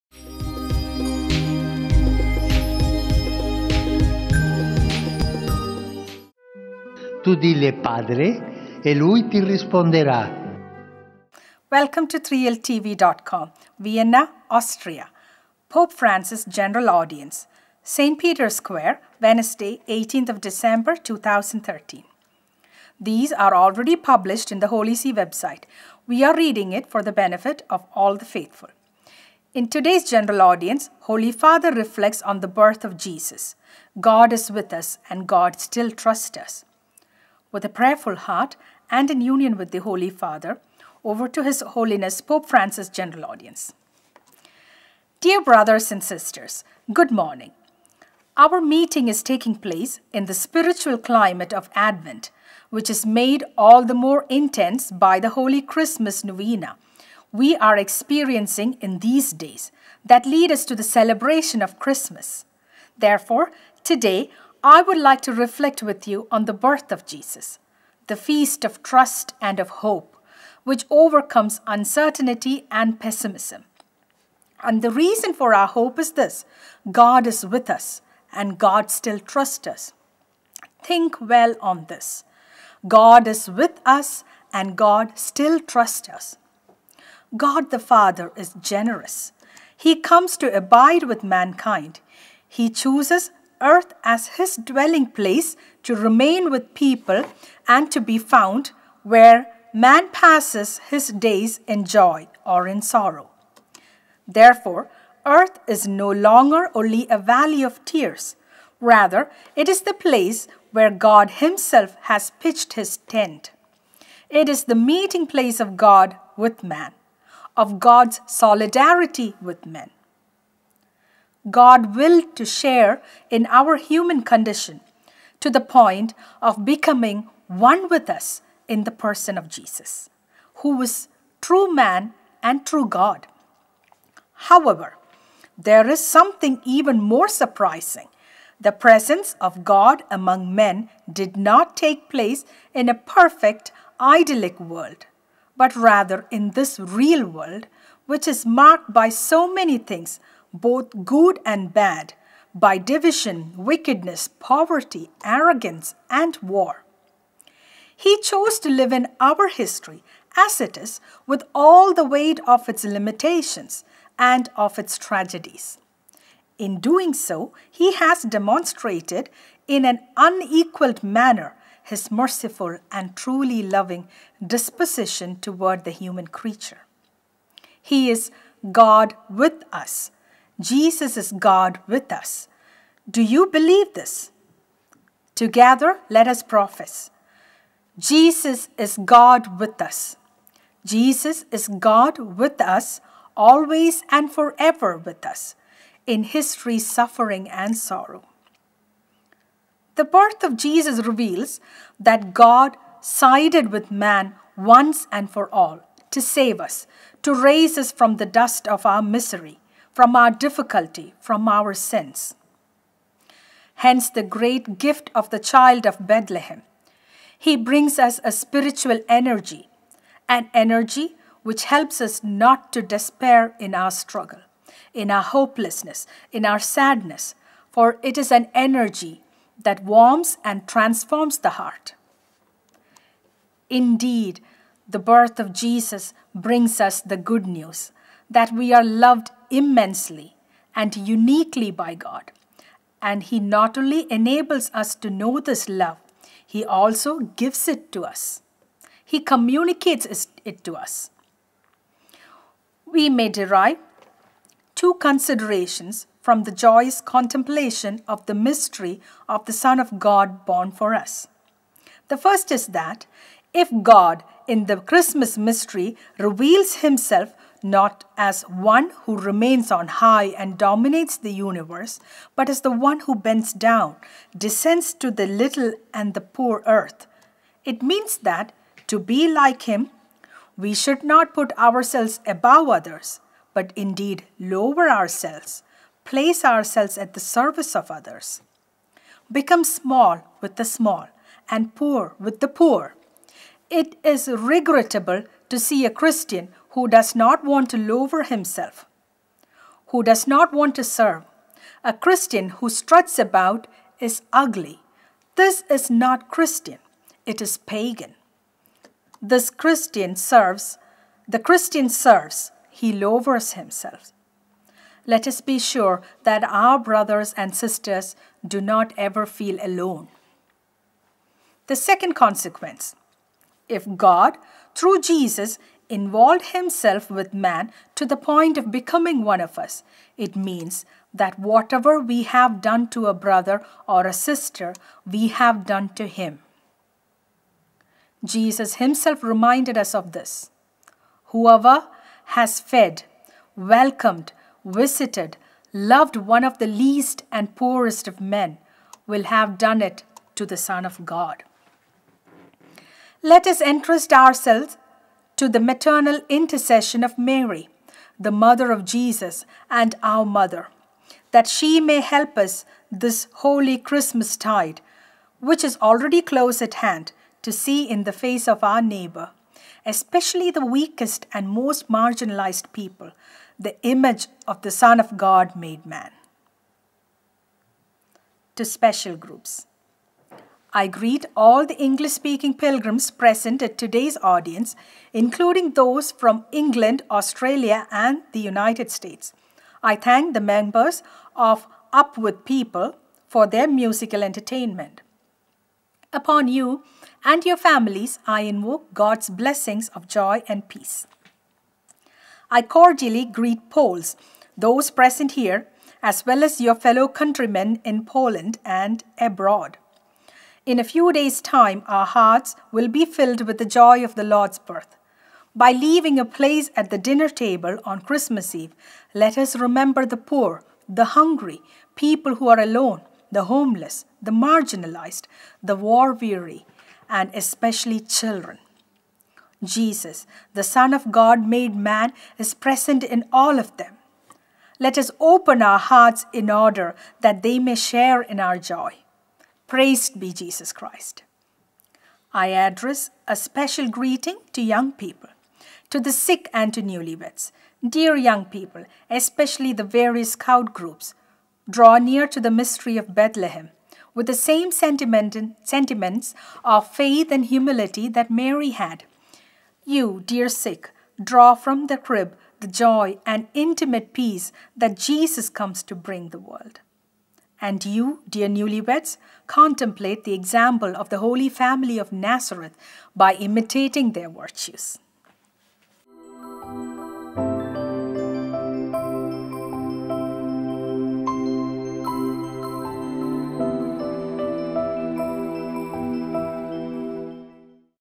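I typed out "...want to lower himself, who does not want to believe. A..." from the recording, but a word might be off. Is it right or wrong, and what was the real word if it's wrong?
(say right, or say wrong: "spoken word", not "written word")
wrong: "serve", not "believe".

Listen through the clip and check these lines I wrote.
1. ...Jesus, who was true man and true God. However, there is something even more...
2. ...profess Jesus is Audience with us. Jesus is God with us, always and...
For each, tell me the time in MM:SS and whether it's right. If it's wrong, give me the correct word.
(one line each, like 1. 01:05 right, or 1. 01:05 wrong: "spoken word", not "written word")
1. 02:09 right
2. 03:06 wrong: "God", not "Audience".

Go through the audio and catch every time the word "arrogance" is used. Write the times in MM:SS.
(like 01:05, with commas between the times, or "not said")
02:35.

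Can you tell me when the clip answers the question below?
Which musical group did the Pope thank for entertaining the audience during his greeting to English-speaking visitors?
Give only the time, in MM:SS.
06:31.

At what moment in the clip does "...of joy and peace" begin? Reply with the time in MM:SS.
06:39.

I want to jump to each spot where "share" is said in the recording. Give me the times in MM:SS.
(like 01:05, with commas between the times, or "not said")
02:02, 07:17.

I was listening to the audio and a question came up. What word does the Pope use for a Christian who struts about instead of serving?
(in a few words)
pagan.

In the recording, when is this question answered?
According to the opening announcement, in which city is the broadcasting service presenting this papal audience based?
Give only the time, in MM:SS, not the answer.
00:13.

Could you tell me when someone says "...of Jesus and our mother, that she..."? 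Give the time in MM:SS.
05:58.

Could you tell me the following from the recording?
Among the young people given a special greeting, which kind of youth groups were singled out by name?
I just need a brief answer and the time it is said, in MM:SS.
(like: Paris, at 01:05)
scout groups, at 07:30.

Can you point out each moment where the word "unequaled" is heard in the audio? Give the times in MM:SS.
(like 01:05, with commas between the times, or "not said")
02:50.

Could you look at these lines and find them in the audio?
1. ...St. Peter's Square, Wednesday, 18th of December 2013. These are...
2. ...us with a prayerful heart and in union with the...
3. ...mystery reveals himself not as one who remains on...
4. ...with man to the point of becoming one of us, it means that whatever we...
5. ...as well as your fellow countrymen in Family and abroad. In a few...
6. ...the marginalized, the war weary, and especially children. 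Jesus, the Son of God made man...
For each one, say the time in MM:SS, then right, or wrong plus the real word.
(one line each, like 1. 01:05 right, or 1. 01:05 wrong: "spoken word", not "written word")
1. 00:17 right
2. 00:36 right
3. 04:25 right
4. 05:27 right
5. 06:46 wrong: "Poland", not "Family"
6. 07:04 right.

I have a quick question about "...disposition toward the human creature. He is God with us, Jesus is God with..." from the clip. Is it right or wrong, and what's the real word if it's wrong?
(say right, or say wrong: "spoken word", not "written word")
right.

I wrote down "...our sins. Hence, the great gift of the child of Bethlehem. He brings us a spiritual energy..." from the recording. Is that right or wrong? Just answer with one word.
right.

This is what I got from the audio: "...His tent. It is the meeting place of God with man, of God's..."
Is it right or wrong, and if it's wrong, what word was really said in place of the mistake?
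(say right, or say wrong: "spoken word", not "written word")
right.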